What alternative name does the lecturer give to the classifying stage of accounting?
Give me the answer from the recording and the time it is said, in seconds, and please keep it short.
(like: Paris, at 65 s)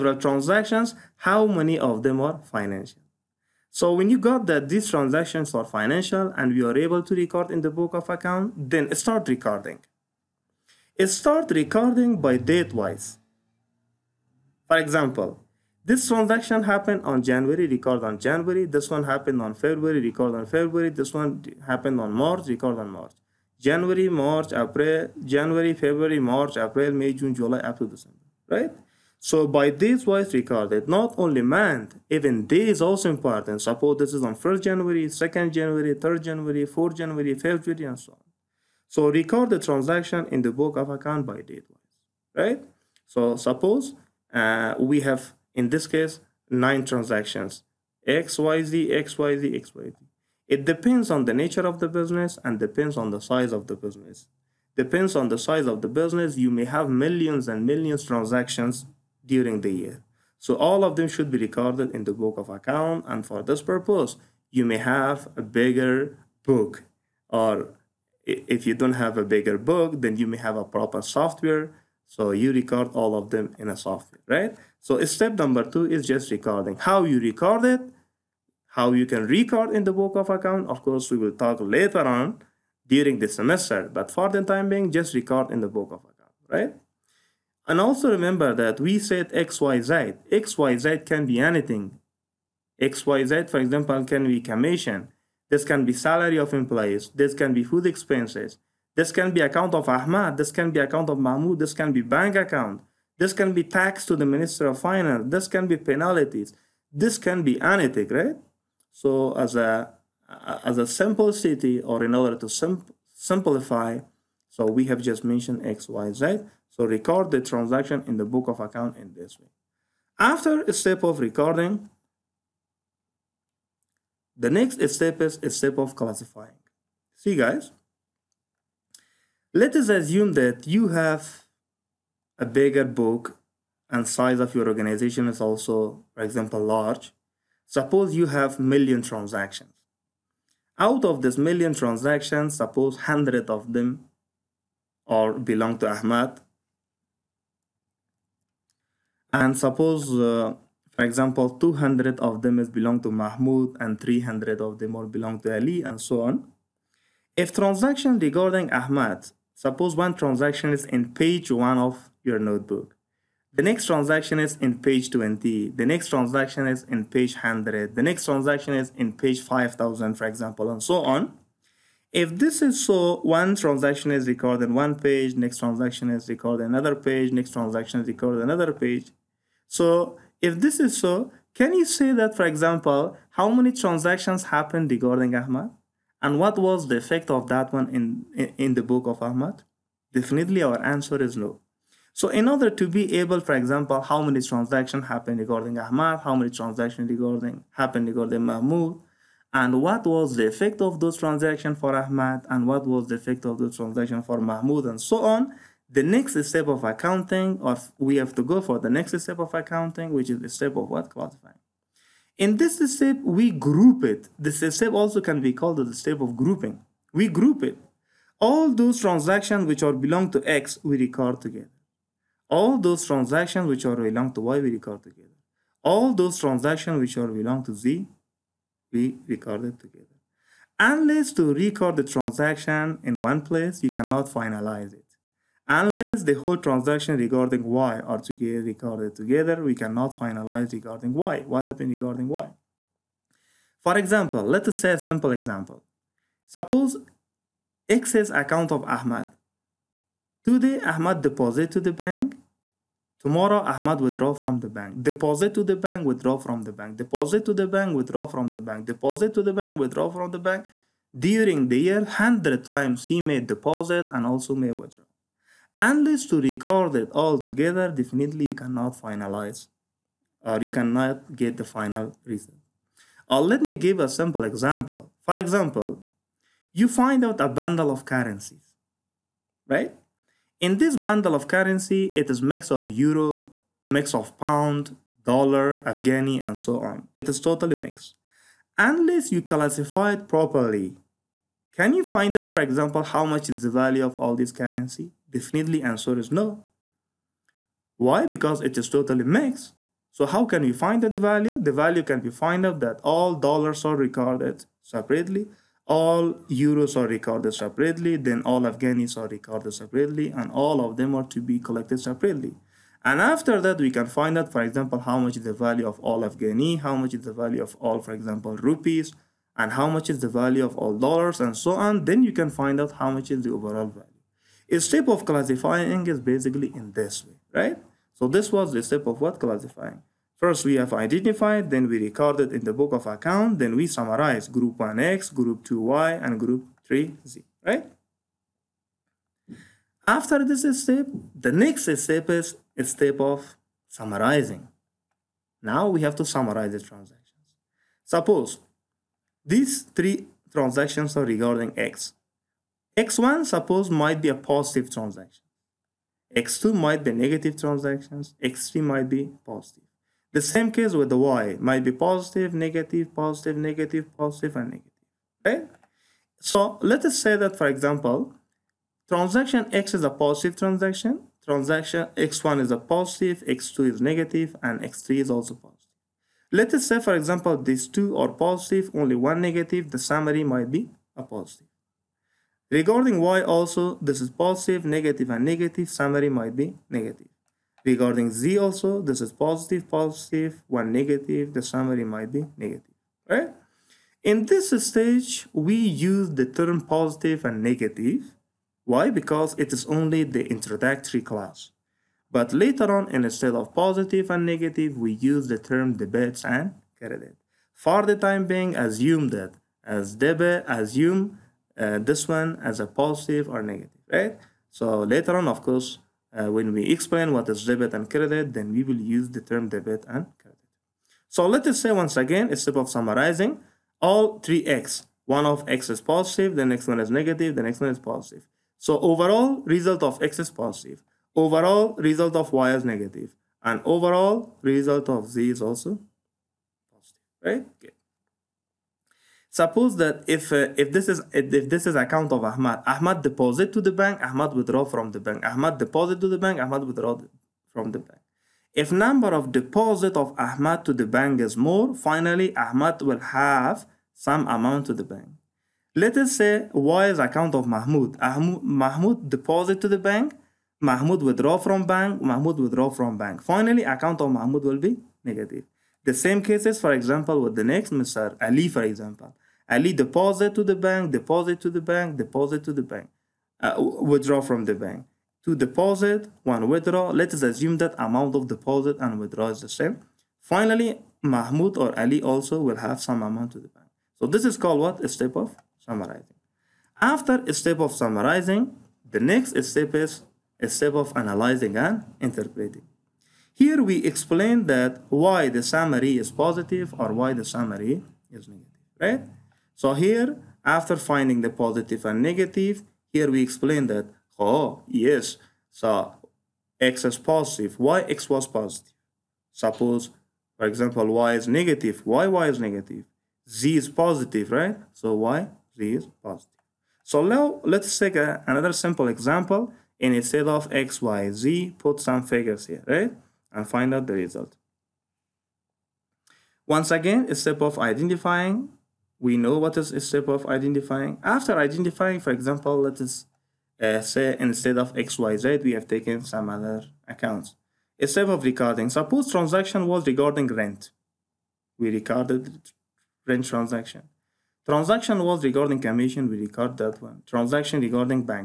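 grouping, at 215 s.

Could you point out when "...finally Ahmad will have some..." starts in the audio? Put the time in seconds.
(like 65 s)
451 s.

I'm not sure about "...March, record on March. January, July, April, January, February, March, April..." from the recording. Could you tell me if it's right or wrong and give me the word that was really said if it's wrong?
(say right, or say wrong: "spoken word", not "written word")
wrong: "March", not "July".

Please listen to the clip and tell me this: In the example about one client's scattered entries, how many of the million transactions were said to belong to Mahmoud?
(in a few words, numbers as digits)
200.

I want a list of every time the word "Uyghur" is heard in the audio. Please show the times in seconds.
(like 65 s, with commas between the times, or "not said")
not said.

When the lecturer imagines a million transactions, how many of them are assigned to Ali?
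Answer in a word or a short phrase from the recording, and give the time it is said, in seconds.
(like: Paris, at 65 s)
300, at 153 s.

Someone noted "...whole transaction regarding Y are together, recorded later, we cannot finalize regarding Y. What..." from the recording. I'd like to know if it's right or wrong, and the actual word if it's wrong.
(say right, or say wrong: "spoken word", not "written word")
wrong: "together", not "later".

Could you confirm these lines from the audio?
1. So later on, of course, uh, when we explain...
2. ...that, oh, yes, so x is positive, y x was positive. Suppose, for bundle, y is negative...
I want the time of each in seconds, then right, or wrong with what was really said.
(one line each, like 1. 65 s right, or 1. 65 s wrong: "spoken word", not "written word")
1. 414 s right
2. 503 s wrong: "example", not "bundle".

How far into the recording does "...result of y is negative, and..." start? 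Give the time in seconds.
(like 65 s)
431 s.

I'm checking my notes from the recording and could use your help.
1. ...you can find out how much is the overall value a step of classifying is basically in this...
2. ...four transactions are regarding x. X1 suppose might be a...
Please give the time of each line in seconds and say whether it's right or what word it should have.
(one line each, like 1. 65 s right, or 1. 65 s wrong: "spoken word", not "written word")
1. 322 s right
2. 349 s wrong: "three", not "four".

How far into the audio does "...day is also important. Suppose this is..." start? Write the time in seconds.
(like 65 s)
32 s.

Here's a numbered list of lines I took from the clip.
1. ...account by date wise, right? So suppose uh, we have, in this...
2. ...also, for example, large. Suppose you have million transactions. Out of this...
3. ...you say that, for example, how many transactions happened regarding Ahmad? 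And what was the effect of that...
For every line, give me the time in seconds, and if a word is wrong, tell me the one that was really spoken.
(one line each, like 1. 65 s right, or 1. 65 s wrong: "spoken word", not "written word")
1. 40 s right
2. 135 s right
3. 181 s right.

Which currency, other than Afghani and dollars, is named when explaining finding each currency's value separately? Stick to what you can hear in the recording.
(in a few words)
rupees.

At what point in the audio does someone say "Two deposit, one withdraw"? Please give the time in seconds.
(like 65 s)
475 s.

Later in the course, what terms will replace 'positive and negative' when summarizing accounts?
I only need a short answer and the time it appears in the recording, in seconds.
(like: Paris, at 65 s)
debits and credit, at 405 s.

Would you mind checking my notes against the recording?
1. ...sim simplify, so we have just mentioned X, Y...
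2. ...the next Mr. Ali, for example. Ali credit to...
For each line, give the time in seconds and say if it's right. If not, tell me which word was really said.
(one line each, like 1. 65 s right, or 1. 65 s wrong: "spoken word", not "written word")
1. 112 s right
2. 467 s wrong: "deposit", not "credit".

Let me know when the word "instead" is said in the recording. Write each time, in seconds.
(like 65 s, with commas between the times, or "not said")
403 s, 422 s, 520 s, 534 s.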